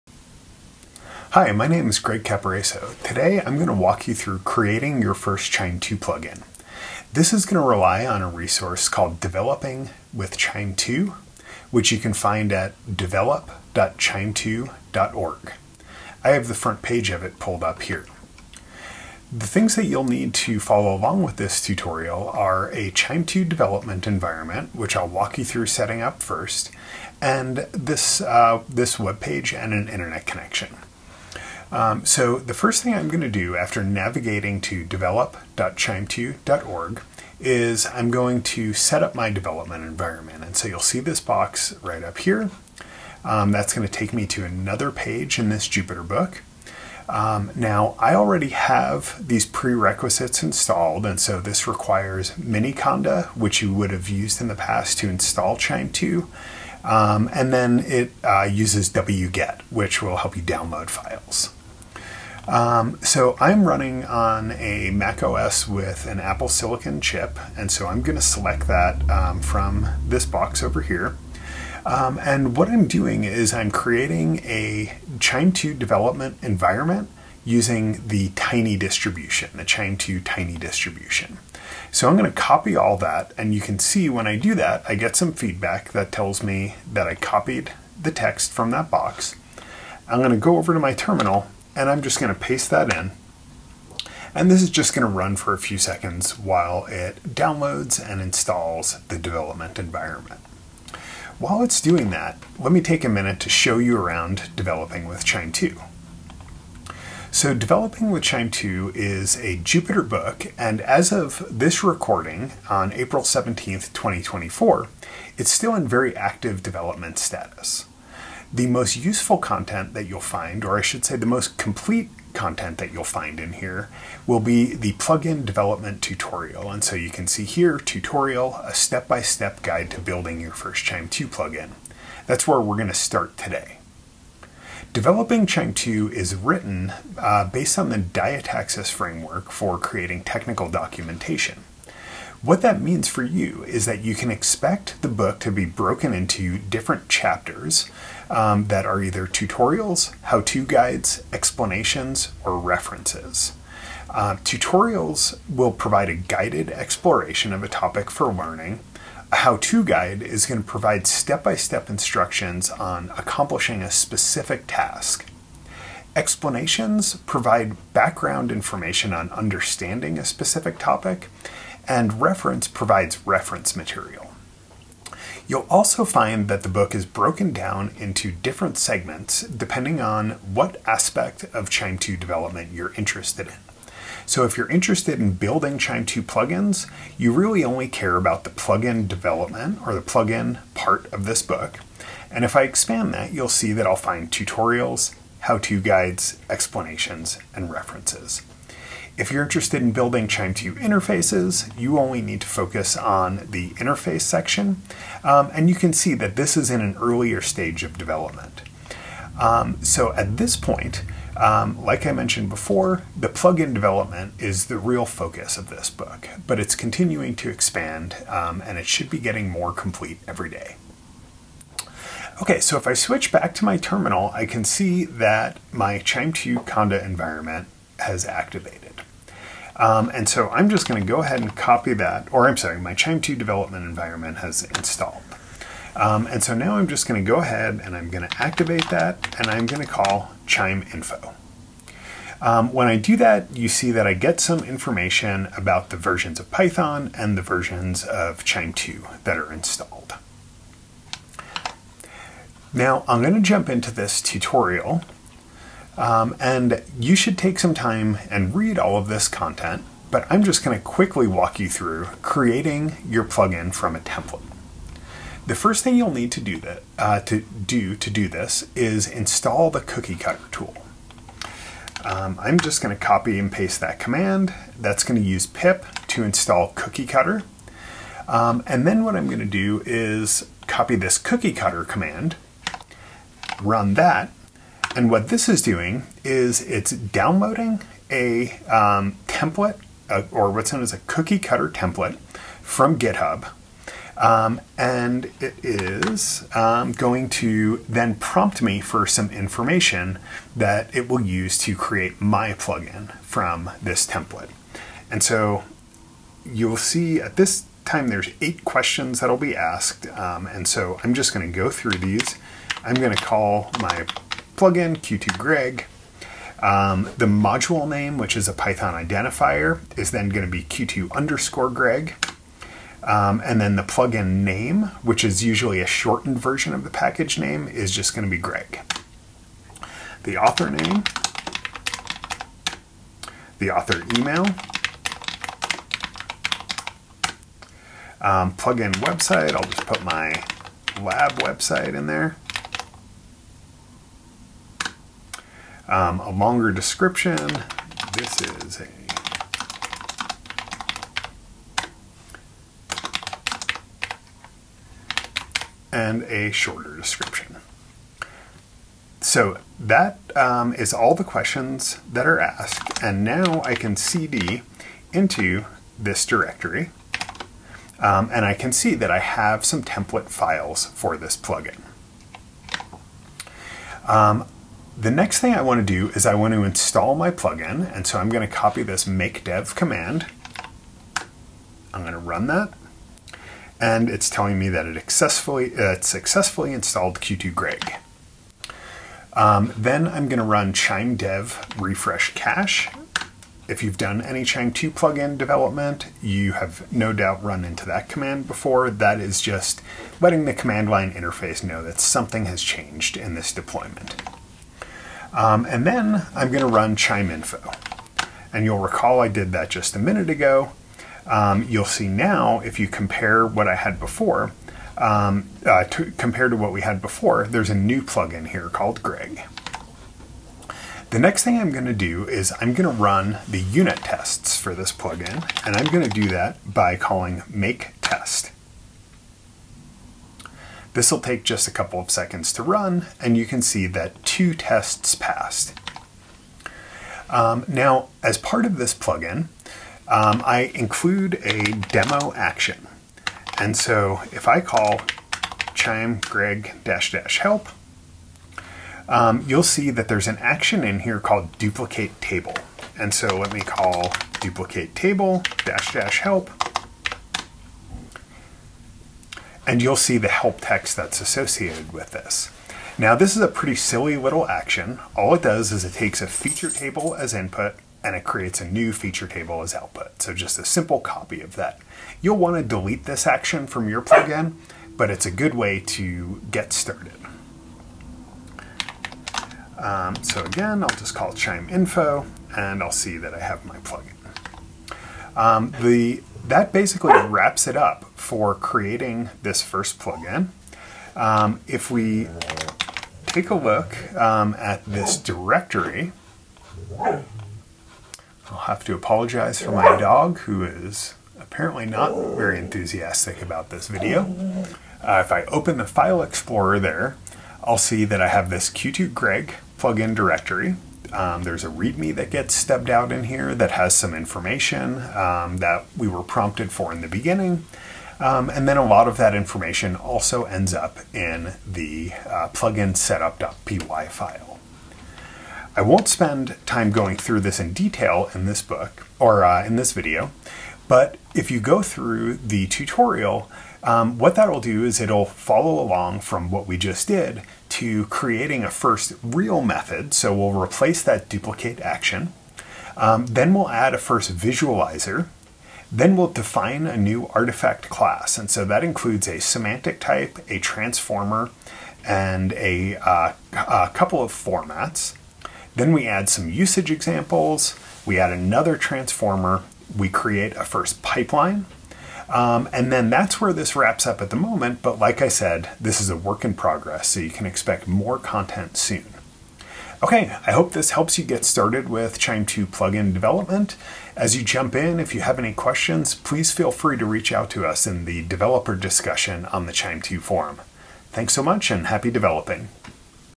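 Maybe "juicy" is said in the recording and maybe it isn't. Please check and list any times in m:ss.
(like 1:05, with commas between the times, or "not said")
not said.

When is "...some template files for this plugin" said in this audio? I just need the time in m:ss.
6:09.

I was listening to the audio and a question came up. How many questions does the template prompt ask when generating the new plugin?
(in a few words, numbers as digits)
8.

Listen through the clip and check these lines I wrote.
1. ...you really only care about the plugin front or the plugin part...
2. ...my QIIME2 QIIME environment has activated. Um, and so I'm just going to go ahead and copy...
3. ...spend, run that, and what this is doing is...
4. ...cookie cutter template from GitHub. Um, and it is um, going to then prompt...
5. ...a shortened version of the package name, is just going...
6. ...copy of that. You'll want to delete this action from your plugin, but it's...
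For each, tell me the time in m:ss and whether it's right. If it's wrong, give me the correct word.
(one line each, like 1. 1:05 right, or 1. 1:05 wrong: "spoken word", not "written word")
1. 3:07 wrong: "development", not "front"
2. 3:45 wrong: "Conda", not "QIIME"
3. 4:41 wrong: "command", not "spend"
4. 4:51 right
5. 5:25 right
6. 7:50 right.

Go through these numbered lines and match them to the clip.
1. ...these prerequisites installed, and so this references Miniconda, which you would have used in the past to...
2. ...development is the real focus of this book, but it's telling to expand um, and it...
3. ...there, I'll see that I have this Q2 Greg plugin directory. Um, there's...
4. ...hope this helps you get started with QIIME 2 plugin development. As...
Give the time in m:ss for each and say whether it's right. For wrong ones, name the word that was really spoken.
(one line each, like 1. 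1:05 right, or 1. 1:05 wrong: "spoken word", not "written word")
1. 0:49 wrong: "requires", not "references"
2. 3:33 wrong: "continuing", not "telling"
3. 8:26 right
4. 9:30 right.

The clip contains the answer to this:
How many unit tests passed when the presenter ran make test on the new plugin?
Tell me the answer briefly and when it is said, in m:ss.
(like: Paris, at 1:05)
2, at 7:14.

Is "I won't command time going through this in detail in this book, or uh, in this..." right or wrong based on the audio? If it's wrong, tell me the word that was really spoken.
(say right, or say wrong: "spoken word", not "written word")
wrong: "spend", not "command".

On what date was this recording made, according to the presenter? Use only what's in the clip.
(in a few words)
April 17th, 2024.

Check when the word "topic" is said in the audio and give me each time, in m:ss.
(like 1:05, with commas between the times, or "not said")
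2:37, 2:50.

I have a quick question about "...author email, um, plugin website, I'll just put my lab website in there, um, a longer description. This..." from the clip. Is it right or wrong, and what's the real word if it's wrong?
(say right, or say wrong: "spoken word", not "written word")
right.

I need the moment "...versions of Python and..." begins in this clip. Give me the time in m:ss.
4:05.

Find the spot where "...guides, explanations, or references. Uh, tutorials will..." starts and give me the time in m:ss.
2:30.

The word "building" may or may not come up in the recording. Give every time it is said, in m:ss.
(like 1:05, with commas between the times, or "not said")
2:10, 3:05, 3:19.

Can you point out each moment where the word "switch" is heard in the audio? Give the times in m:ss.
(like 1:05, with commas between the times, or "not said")
3:42.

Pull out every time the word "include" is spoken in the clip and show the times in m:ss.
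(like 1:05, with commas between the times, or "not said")
7:20, 9:08.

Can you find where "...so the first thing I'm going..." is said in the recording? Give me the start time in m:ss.
0:32.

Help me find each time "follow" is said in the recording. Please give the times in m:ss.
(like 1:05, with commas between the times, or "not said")
0:20, 8:55.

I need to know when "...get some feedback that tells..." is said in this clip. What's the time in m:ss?
1:24.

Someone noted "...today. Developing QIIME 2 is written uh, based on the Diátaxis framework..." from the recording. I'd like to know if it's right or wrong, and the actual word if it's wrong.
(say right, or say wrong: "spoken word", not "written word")
right.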